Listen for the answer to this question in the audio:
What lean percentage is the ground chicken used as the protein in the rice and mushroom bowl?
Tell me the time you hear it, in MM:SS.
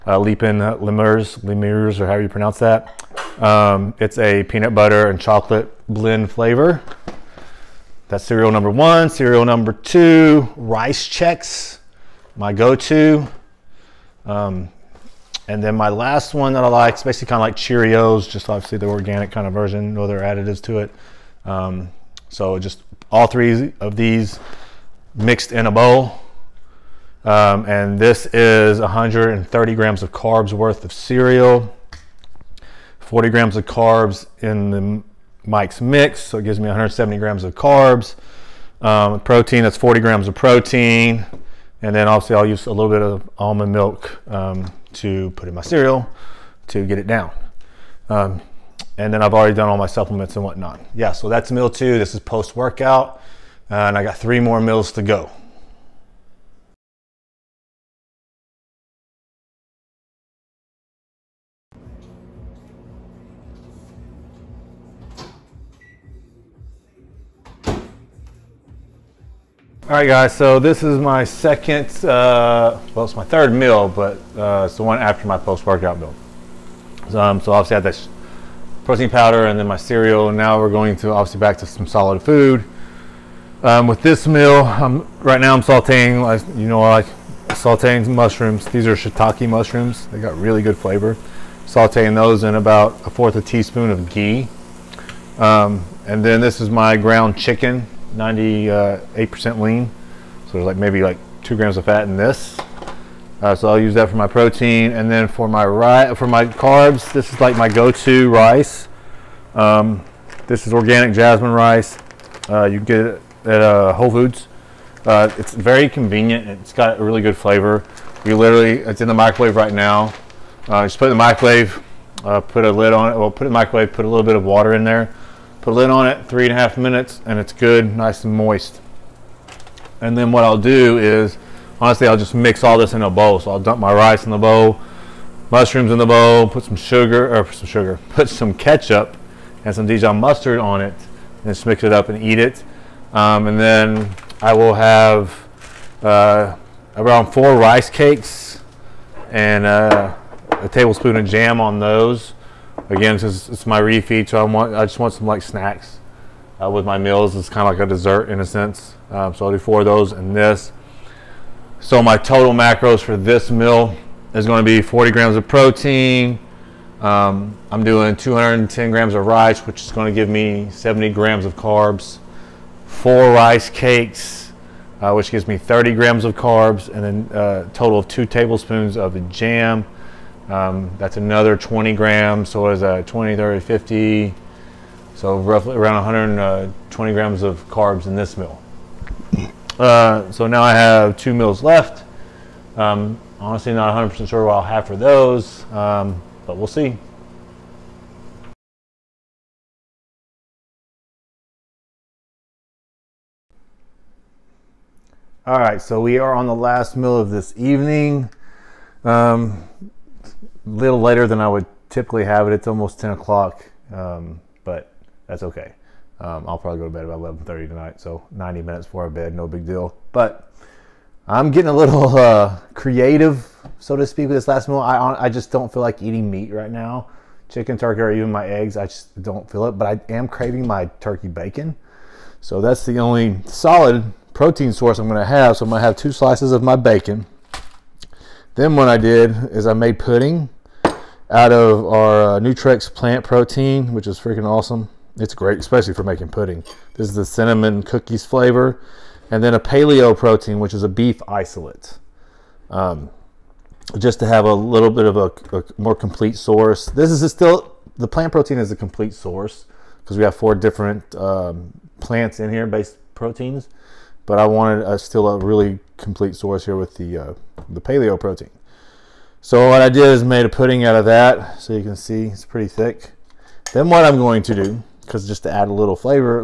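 01:38.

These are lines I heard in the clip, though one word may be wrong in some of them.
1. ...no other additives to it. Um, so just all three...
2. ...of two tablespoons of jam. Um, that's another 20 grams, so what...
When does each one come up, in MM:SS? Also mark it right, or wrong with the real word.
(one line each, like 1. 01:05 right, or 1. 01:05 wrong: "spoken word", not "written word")
1. 00:19 right
2. 02:57 right.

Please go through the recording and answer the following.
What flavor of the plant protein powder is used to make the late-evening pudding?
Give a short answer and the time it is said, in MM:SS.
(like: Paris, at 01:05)
cinnamon cookies, at 04:07.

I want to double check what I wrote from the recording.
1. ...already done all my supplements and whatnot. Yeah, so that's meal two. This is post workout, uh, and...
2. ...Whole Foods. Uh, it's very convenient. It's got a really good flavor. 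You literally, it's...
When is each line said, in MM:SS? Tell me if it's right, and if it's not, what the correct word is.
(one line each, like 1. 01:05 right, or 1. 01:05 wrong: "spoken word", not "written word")
1. 00:49 right
2. 01:53 right.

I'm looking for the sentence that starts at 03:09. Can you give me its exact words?
Uh, so now I have two meals left.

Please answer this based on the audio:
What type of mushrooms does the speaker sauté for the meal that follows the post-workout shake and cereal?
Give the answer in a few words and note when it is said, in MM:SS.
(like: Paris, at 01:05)
shiitake, at 01:28.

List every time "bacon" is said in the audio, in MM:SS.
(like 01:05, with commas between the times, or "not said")
03:51, 03:56.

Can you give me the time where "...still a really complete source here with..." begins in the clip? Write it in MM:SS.
04:24.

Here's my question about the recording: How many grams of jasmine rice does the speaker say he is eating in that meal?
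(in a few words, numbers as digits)
210 grams.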